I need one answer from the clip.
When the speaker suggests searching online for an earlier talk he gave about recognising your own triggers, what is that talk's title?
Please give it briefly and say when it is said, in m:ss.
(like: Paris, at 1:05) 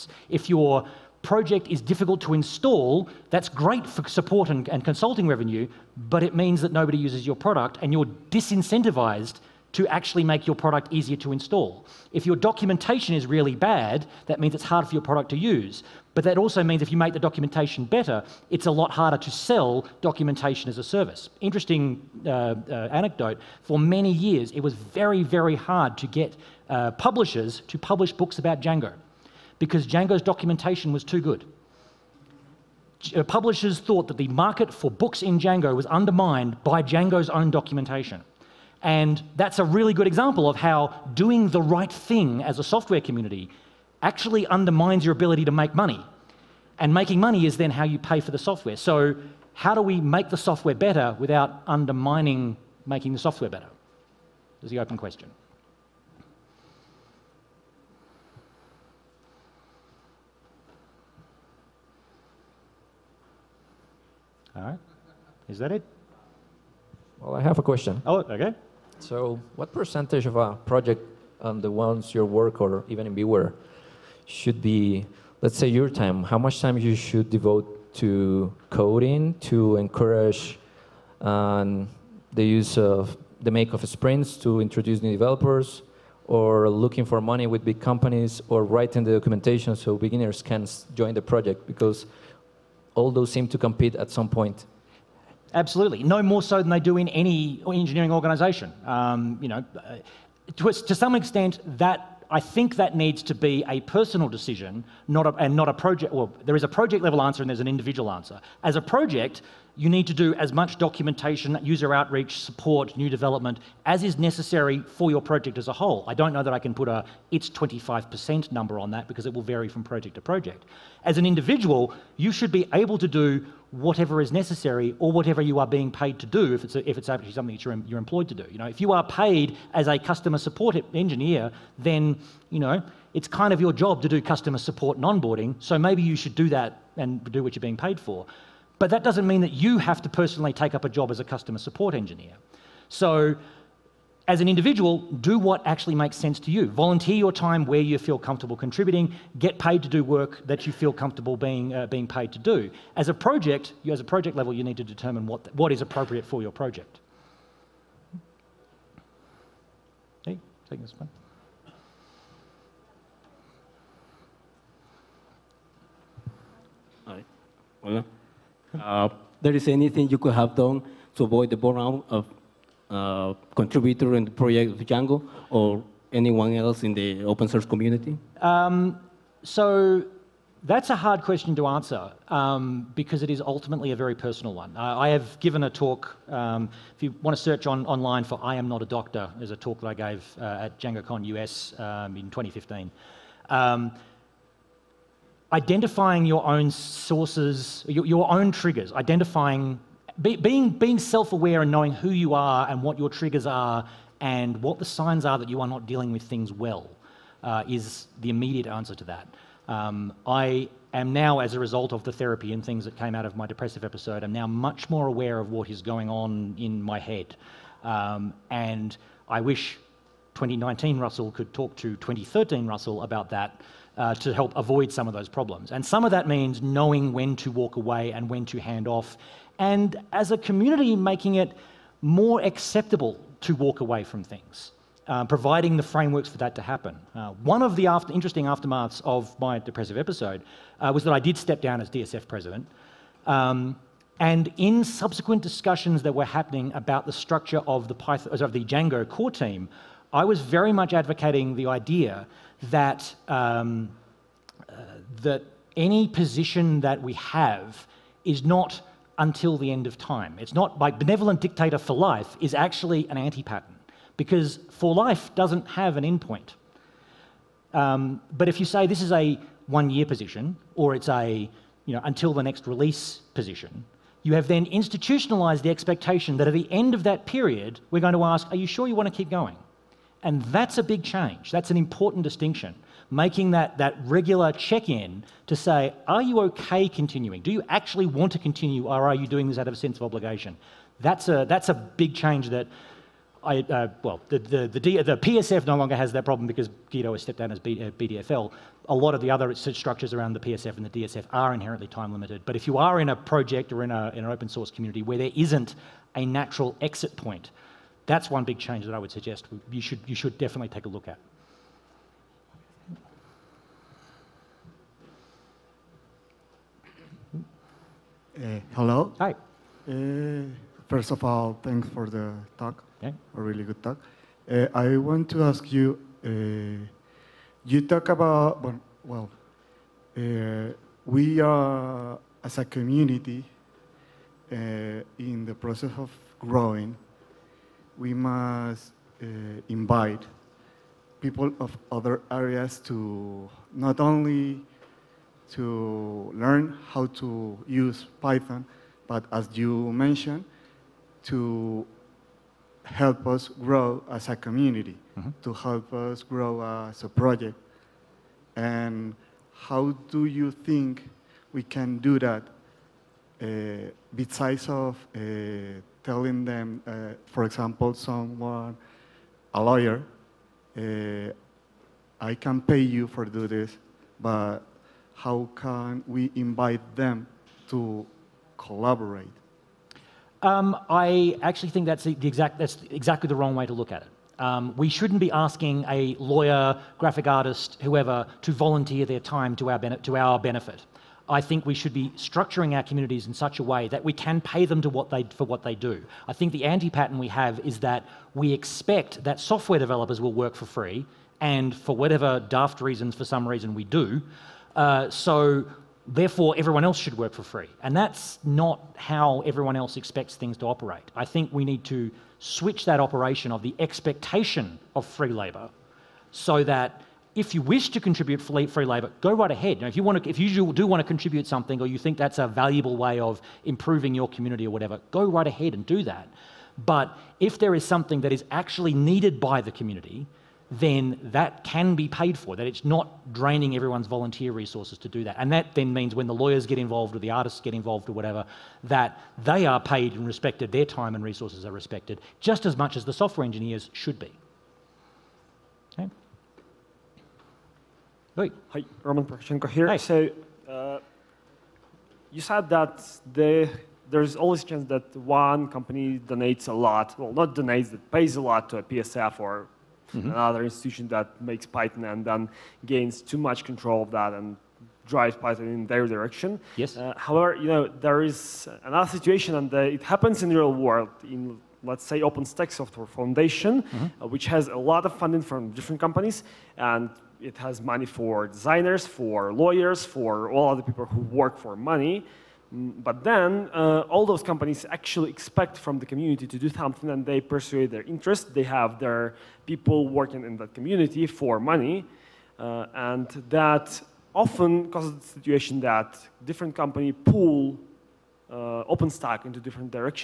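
I Am Not a Doctor, at 3:08.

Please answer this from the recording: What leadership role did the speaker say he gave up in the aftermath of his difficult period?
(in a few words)
DSF president.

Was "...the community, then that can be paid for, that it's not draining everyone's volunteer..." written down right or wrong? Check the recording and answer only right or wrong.
right.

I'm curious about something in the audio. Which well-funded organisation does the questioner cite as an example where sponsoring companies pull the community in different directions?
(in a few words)
OpenStack Software Foundation.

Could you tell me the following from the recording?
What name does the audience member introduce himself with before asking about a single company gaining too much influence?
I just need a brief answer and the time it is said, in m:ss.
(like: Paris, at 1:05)
Roman Poroshenko, at 7:29.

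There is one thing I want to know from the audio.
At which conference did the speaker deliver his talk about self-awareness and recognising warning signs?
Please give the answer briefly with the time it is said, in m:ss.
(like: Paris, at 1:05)
DjangoCon US, at 3:10.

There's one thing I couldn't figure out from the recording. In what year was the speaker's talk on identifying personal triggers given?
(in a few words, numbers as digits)
2015.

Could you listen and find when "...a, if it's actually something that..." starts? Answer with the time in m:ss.
2:06.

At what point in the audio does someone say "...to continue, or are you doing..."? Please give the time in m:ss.
4:48.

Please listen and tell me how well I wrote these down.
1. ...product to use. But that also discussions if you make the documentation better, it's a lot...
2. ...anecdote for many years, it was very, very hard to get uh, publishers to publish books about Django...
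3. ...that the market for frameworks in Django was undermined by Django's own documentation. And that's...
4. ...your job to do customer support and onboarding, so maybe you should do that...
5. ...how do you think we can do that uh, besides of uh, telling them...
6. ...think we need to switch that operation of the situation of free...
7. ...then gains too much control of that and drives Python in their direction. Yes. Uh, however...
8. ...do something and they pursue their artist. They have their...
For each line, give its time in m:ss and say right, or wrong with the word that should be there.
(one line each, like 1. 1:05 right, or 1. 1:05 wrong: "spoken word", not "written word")
1. 0:15 wrong: "means", not "discussions"
2. 0:22 right
3. 0:34 wrong: "books", not "frameworks"
4. 2:13 right
5. 5:59 right
6. 6:51 wrong: "expectation", not "situation"
7. 7:42 right
8. 8:06 wrong: "interest", not "artist".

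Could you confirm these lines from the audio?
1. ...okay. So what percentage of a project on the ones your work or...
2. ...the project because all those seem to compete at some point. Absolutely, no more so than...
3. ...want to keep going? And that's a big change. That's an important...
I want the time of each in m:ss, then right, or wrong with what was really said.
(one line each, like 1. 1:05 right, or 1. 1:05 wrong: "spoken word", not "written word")
1. 1:08 right
2. 1:31 right
3. 4:38 right.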